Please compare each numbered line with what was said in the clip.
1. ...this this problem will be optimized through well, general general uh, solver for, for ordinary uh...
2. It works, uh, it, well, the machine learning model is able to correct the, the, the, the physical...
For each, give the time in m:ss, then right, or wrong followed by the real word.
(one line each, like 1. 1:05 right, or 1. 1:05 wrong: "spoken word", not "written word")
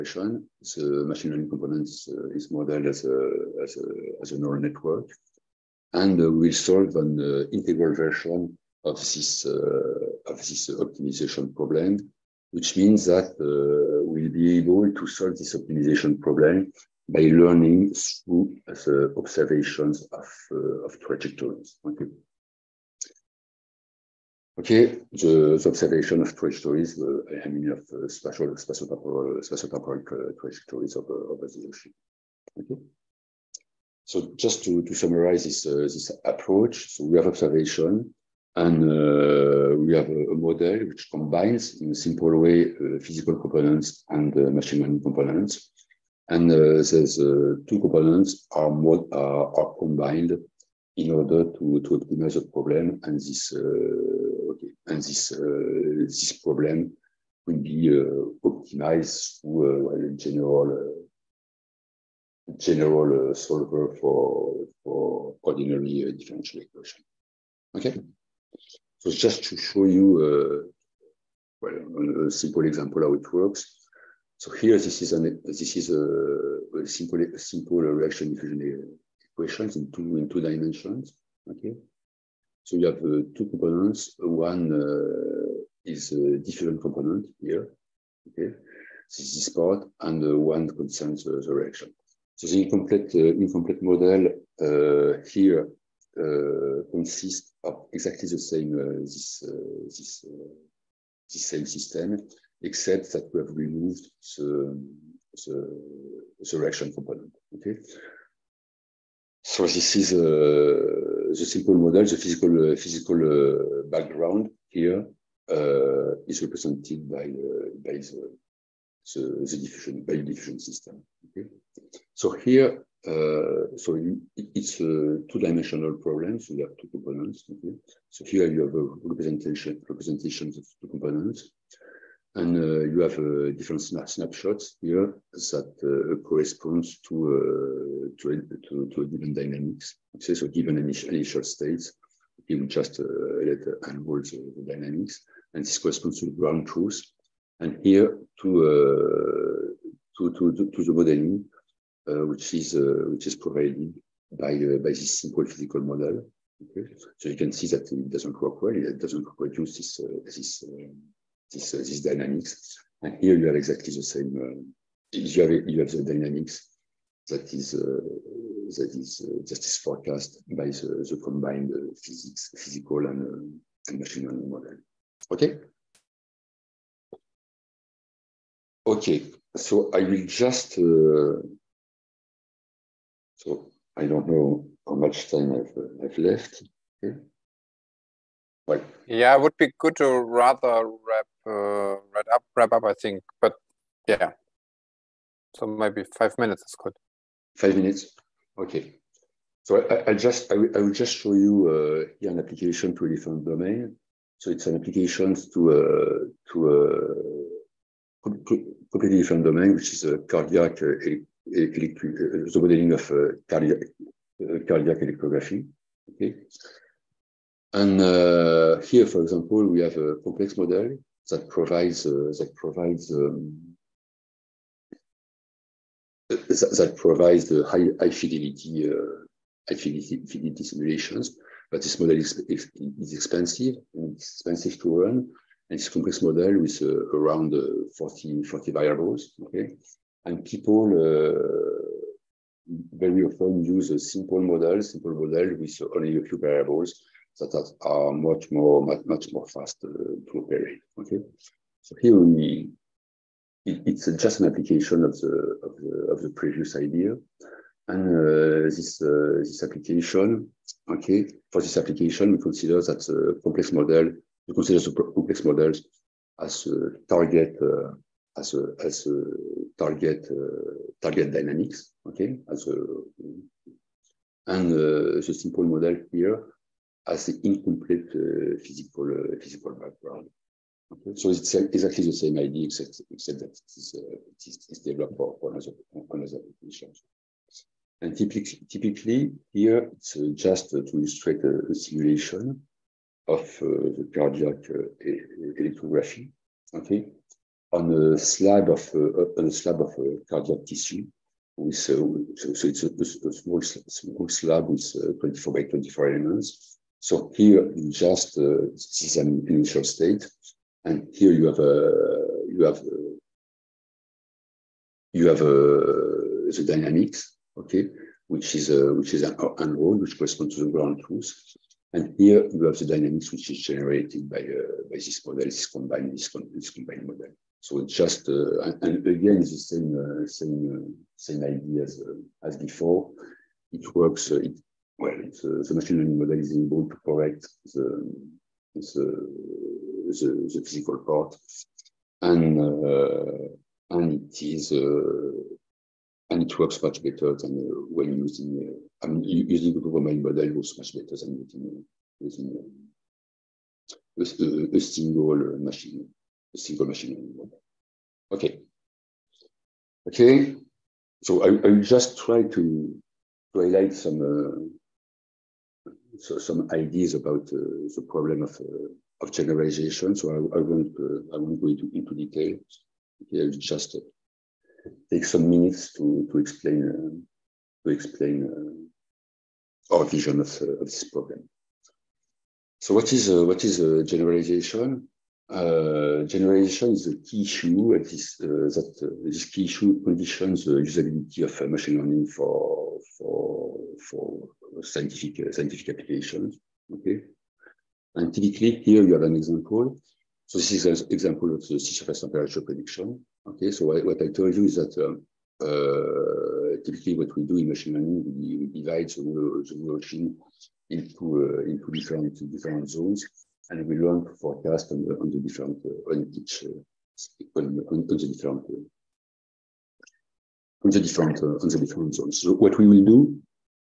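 1. 0:54 right
2. 5:33 right.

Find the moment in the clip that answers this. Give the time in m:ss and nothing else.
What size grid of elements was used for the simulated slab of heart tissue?
5:05.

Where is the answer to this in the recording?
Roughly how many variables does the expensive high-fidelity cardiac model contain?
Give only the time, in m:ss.
3:57.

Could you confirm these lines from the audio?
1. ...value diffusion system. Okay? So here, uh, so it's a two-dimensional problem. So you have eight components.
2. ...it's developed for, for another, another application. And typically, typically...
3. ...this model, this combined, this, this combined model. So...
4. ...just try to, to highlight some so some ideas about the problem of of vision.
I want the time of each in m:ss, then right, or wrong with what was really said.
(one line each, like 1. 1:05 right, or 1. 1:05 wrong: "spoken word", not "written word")
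1. 2:00 wrong: "two", not "eight"
2. 4:44 right
3. 5:24 right
4. 6:01 wrong: "generalization", not "vision".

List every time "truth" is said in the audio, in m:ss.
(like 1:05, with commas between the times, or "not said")
2:26, 5:21.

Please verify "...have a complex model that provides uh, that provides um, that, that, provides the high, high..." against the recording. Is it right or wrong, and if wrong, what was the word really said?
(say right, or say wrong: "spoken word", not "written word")
right.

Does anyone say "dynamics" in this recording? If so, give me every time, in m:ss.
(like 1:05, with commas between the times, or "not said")
2:19, 2:24, 2:42, 2:46, 4:31, 5:16, 5:22.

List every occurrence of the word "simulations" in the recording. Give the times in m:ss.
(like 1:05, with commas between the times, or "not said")
3:50, 4:51.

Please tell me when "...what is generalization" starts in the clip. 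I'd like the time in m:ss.
6:23.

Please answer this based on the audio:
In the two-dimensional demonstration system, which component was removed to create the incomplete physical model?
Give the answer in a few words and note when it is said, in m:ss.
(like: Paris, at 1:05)
reaction component, at 1:46.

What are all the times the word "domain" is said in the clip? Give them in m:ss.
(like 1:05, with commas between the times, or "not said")
3:23, 3:29.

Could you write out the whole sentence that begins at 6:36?
Okay, and typically here you have an example.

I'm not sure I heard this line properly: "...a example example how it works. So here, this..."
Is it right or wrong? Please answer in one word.
wrong.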